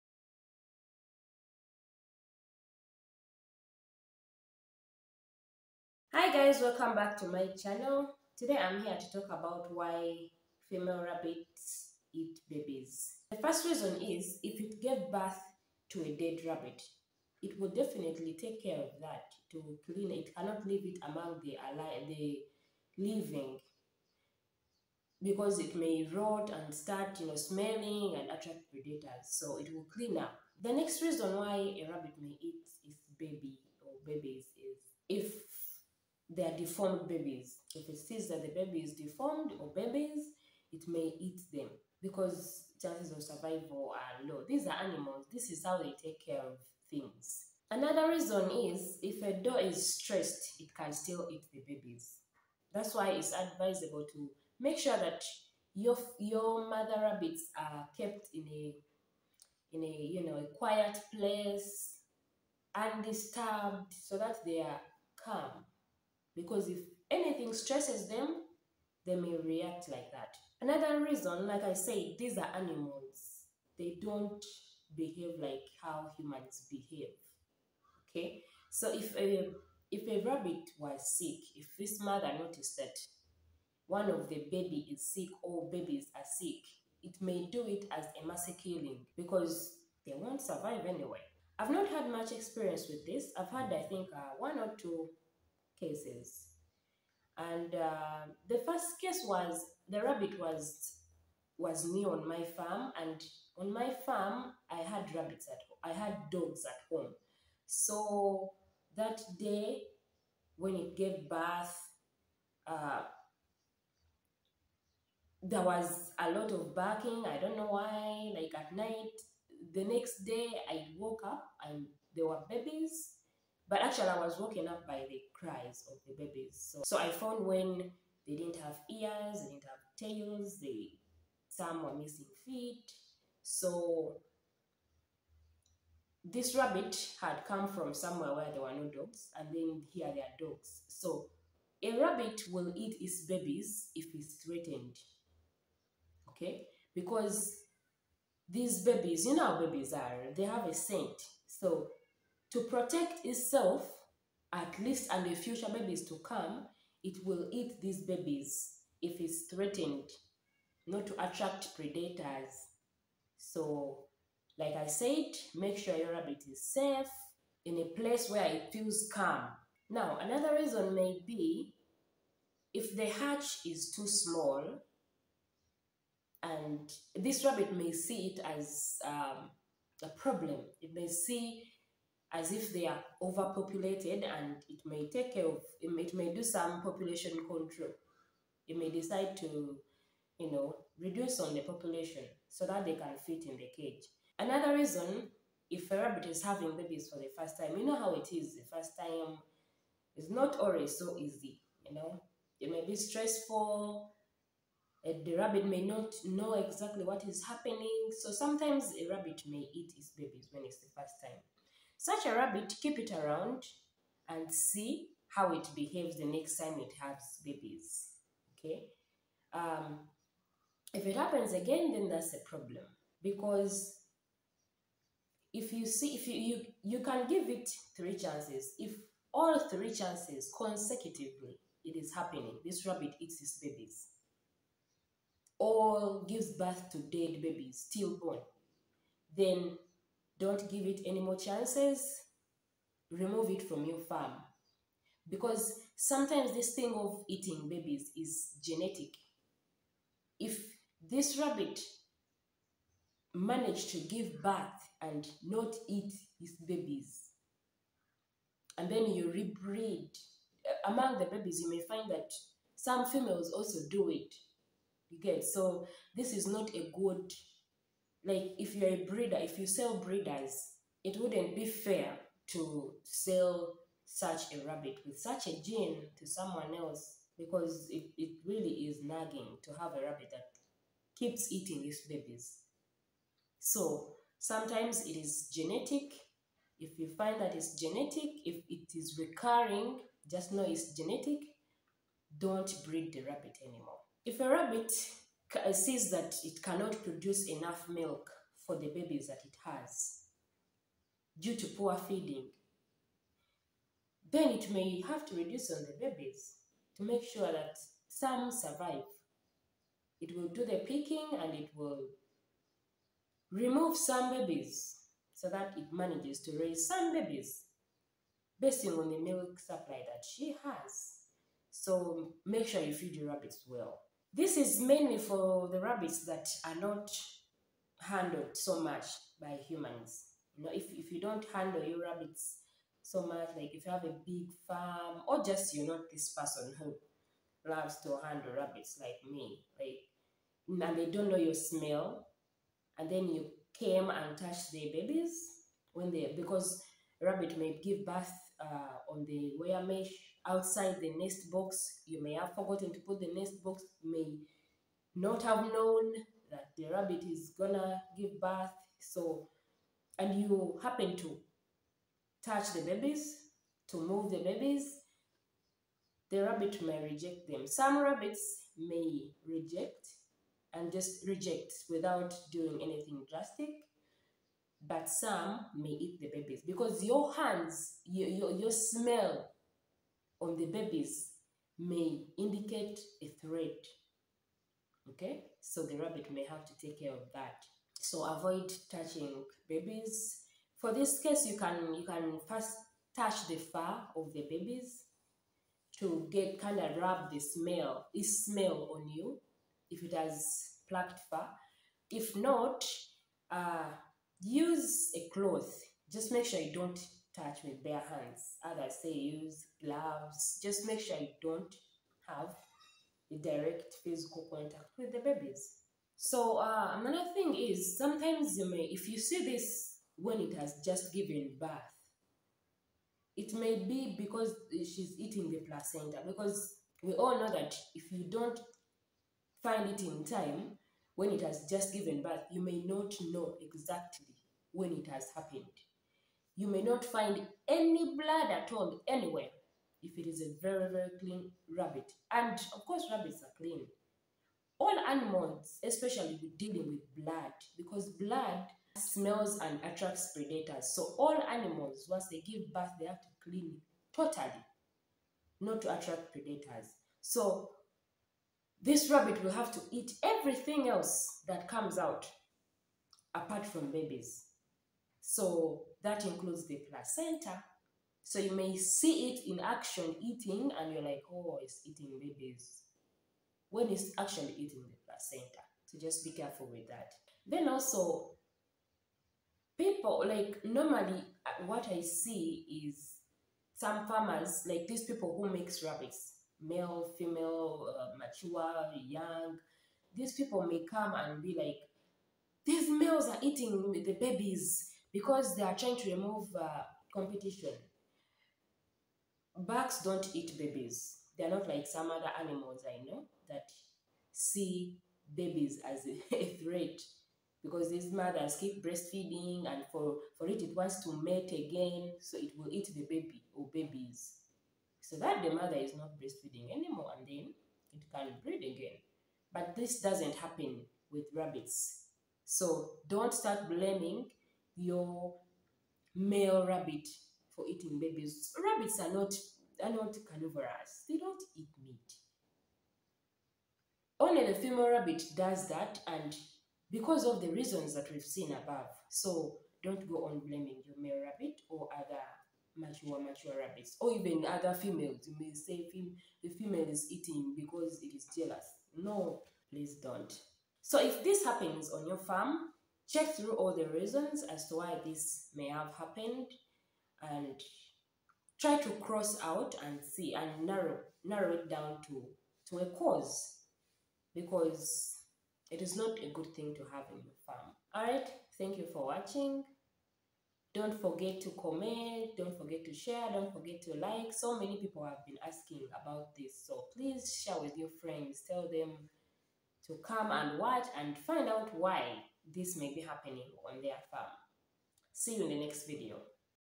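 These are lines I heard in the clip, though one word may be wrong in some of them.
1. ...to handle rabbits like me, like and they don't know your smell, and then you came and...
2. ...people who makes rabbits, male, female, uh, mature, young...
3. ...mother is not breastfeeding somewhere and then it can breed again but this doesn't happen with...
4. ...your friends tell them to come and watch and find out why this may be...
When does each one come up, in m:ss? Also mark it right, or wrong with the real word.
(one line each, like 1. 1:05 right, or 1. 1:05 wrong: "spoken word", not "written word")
1. 5:38 right
2. 8:05 right
3. 8:35 wrong: "anymore", not "somewhere"
4. 9:37 right.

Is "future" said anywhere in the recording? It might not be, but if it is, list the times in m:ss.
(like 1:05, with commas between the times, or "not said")
2:35.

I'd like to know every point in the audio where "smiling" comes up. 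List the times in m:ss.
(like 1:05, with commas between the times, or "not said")
not said.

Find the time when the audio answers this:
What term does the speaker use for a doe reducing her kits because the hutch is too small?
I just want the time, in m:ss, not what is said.
3:06.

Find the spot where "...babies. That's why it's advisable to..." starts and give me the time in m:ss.
0:51.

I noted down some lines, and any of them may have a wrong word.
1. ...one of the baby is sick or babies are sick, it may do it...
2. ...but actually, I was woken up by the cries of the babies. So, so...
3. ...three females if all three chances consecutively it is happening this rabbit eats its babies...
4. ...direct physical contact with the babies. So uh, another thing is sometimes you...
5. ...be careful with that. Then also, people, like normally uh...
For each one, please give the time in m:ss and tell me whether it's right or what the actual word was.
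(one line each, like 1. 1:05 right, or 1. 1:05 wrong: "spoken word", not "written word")
1. 1:23 right
2. 2:03 right
3. 3:47 wrong: "chances", not "females"
4. 6:53 right
5. 7:56 right.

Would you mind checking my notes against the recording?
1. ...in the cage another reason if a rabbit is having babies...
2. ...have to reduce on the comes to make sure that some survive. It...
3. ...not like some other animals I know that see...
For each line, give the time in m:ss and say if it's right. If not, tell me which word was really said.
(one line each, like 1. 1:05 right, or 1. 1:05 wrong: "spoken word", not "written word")
1. 3:13 right
2. 5:05 wrong: "babies", not "comes"
3. 8:21 right.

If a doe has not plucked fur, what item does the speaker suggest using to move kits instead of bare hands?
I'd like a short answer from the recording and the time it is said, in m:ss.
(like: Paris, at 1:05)
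A cloth, at 6:45.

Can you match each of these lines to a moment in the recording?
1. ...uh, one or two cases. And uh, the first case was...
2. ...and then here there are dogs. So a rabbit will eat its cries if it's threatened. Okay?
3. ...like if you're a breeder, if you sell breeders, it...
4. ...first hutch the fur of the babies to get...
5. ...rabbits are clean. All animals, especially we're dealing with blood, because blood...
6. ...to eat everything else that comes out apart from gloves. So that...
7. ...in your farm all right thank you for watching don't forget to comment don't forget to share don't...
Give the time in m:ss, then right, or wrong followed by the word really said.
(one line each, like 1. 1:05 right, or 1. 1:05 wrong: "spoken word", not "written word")
1. 1:34 right
2. 2:19 wrong: "babies", not "cries"
3. 4:28 right
4. 6:32 wrong: "touch", not "hutch"
5. 7:23 right
6. 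7:39 wrong: "babies", not "gloves"
7. 9:27 right.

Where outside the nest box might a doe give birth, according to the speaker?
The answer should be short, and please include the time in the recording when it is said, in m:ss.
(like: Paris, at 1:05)
On the wire mesh, at 5:49.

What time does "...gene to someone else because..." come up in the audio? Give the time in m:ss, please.
4:35.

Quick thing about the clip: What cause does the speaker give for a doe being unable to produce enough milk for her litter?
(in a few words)
Poor feeding.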